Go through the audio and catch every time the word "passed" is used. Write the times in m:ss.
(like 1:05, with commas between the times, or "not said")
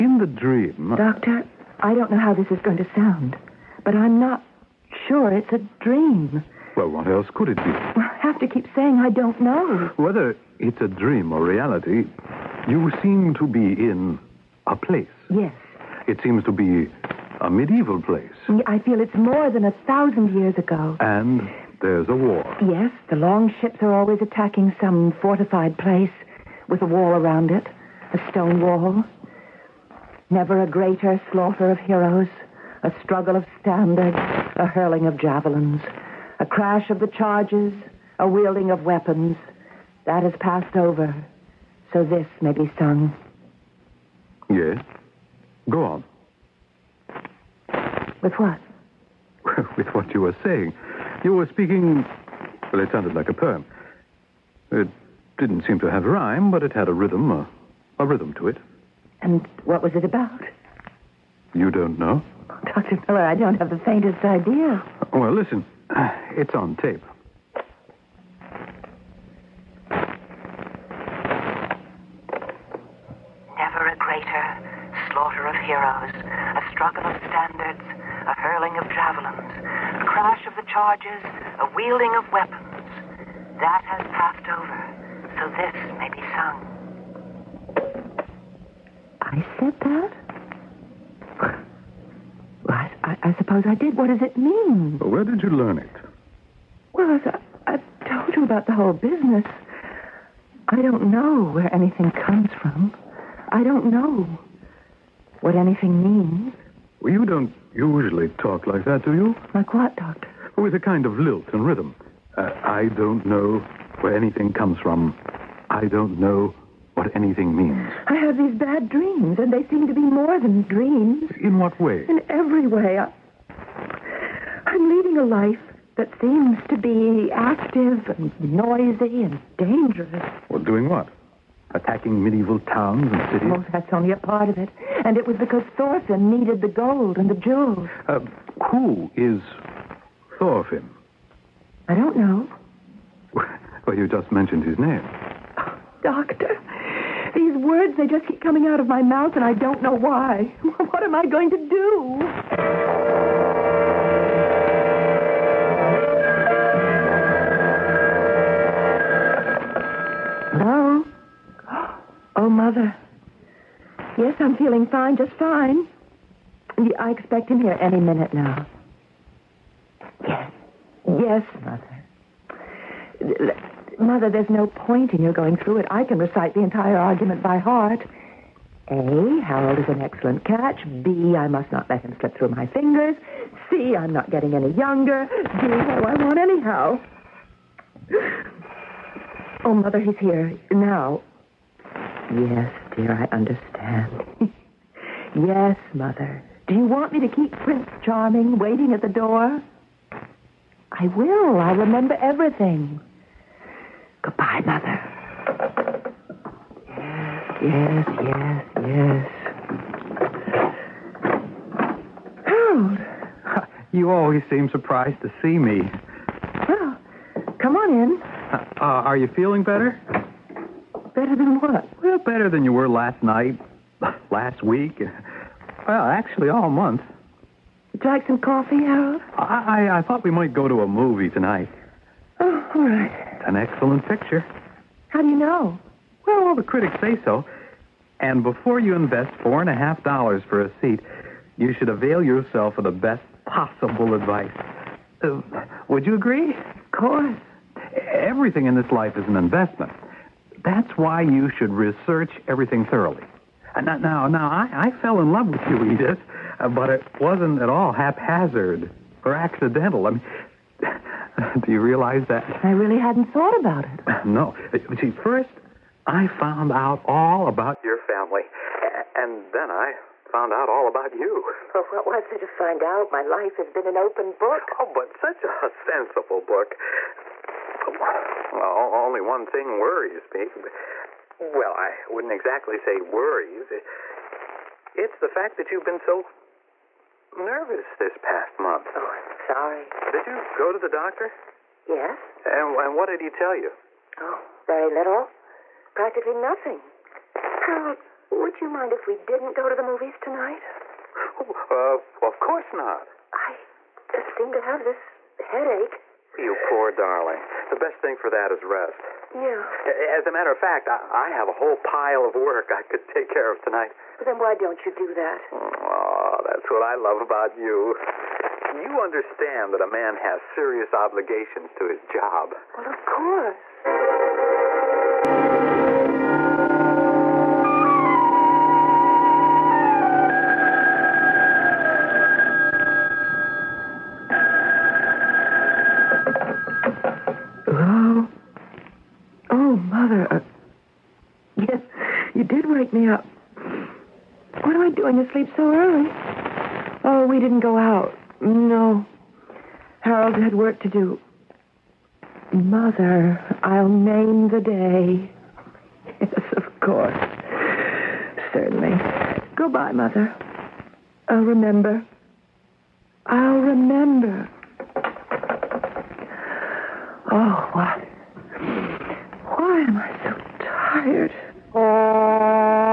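0:40, 1:24.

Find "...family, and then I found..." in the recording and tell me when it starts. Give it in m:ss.
4:27.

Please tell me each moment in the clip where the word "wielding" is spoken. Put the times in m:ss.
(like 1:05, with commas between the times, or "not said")
0:38, 1:21.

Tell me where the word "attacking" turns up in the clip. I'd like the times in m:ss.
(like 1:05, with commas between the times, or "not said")
0:24, 2:11.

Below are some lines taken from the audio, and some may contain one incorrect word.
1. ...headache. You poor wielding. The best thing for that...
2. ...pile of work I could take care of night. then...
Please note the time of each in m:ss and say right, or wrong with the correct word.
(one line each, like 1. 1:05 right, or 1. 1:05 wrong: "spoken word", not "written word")
1. 5:05 wrong: "darling", not "wielding"
2. 5:11 wrong: "tonight", not "night".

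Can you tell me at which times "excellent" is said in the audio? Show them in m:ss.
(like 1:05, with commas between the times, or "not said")
3:00, 3:53.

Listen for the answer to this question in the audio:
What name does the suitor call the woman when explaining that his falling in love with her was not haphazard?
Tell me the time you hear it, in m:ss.
4:15.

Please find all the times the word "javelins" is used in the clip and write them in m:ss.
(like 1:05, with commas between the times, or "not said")
0:35, 1:18.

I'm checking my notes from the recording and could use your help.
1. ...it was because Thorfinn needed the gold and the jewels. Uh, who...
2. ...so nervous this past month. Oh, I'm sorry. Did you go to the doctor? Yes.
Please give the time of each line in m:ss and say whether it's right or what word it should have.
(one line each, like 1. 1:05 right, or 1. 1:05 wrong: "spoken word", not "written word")
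1. 2:15 right
2. 4:46 right.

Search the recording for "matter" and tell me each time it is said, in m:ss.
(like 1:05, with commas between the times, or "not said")
5:10.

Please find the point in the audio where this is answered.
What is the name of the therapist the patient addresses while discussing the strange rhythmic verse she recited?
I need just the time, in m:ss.
1:02.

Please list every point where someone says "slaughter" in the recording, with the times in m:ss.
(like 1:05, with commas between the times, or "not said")
0:31, 1:15.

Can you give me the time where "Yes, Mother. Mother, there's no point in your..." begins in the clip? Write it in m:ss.
2:51.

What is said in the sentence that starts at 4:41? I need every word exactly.
Well, I wouldn't exactly say worries.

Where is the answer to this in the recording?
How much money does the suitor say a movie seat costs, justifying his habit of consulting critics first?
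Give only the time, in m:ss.
3:59.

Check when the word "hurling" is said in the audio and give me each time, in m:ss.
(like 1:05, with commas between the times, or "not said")
0:34, 1:18.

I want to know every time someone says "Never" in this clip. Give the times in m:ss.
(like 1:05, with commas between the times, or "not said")
0:30, 1:13.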